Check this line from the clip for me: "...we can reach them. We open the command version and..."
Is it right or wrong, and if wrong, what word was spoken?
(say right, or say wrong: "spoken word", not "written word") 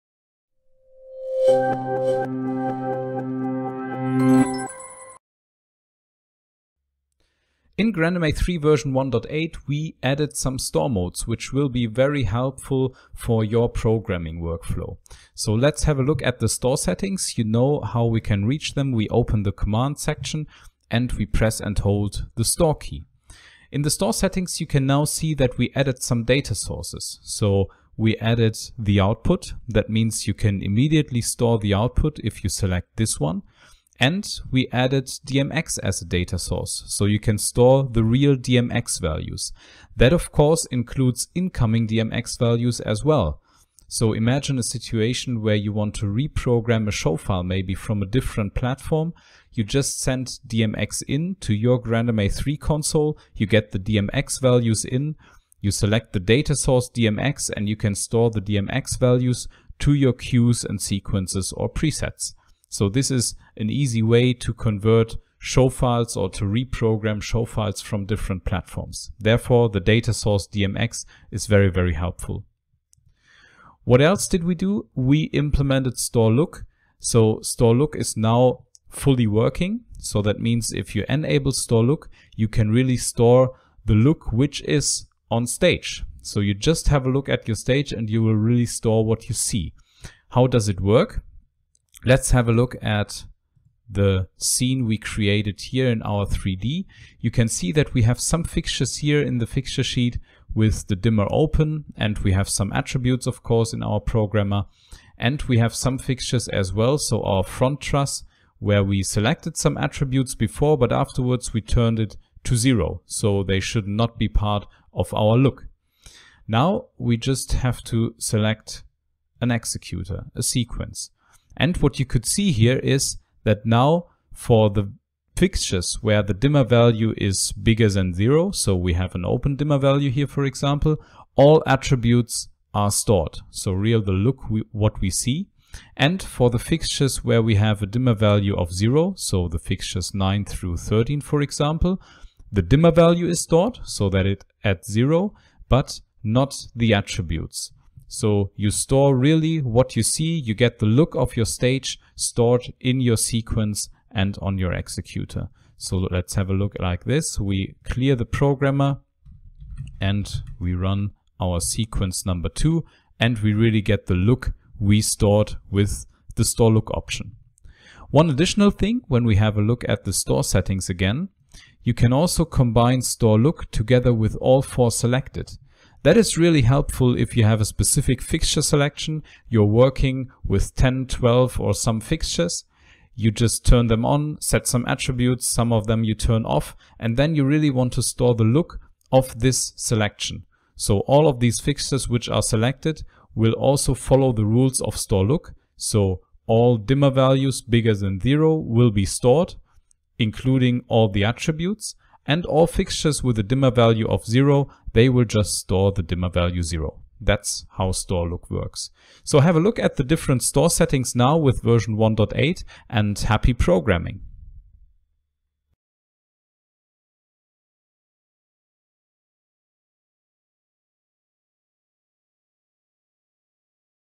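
wrong: "section", not "version".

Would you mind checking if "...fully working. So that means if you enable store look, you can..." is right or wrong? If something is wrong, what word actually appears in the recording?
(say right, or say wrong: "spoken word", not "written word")
right.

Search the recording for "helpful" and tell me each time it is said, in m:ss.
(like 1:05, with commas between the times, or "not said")
0:12, 1:11, 2:56.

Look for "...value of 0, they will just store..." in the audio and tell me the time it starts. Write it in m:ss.
3:23.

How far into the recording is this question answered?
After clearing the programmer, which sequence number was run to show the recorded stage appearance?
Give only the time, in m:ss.
2:42.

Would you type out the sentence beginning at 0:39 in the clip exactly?
That of course includes incoming DMX values as well.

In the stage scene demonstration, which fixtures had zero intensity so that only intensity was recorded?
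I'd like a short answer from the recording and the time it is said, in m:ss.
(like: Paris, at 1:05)
9 through 13, at 2:20.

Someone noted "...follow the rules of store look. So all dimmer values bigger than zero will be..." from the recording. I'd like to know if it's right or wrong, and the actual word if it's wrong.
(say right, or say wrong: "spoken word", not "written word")
right.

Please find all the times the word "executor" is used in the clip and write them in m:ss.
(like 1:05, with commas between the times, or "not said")
1:59, 2:34.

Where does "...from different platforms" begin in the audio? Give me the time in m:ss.
1:07.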